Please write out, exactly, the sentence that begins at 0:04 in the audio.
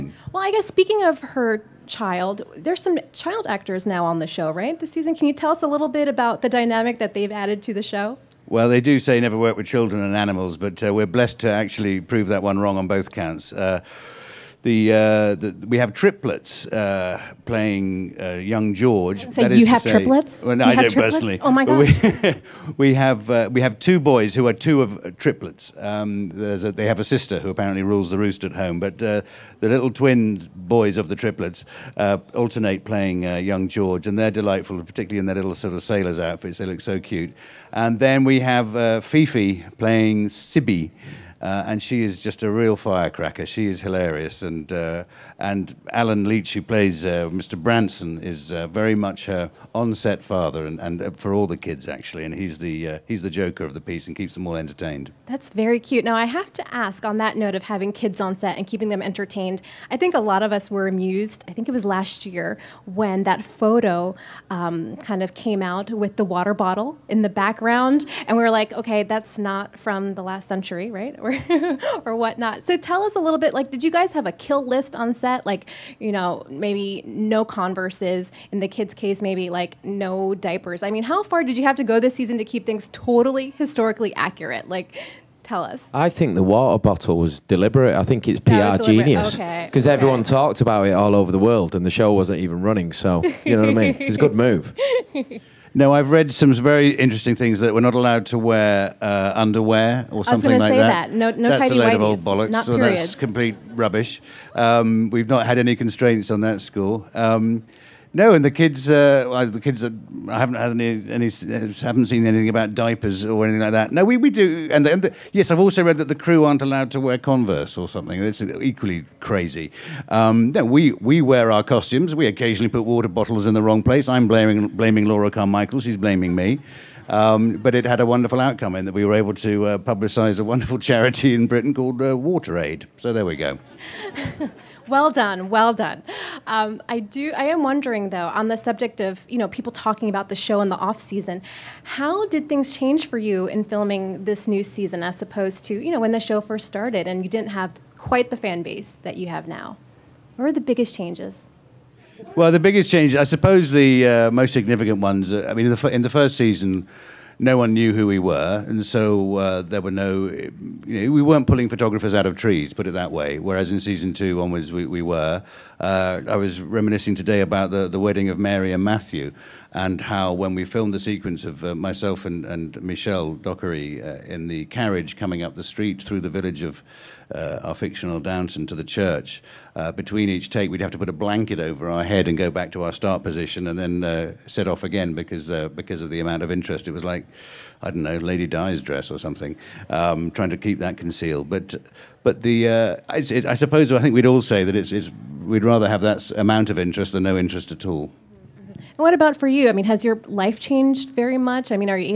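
This season, can you tell us a little bit about the dynamic that they've added to the show?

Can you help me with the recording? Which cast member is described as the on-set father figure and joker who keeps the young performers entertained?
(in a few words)
Allen Leech.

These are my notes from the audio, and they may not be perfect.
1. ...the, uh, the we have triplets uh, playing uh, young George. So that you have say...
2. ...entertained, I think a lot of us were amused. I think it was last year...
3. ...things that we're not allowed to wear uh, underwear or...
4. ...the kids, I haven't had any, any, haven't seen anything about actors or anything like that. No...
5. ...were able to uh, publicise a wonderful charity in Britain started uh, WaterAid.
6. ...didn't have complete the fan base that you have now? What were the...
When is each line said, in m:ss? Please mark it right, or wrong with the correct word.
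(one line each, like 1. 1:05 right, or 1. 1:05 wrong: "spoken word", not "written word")
1. 0:14 right
2. 0:59 right
3. 1:37 right
4. 1:49 wrong: "diapers", not "actors"
5. 2:09 wrong: "called", not "started"
6. 2:27 wrong: "quite", not "complete".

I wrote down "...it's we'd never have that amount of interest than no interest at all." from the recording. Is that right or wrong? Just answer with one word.
wrong.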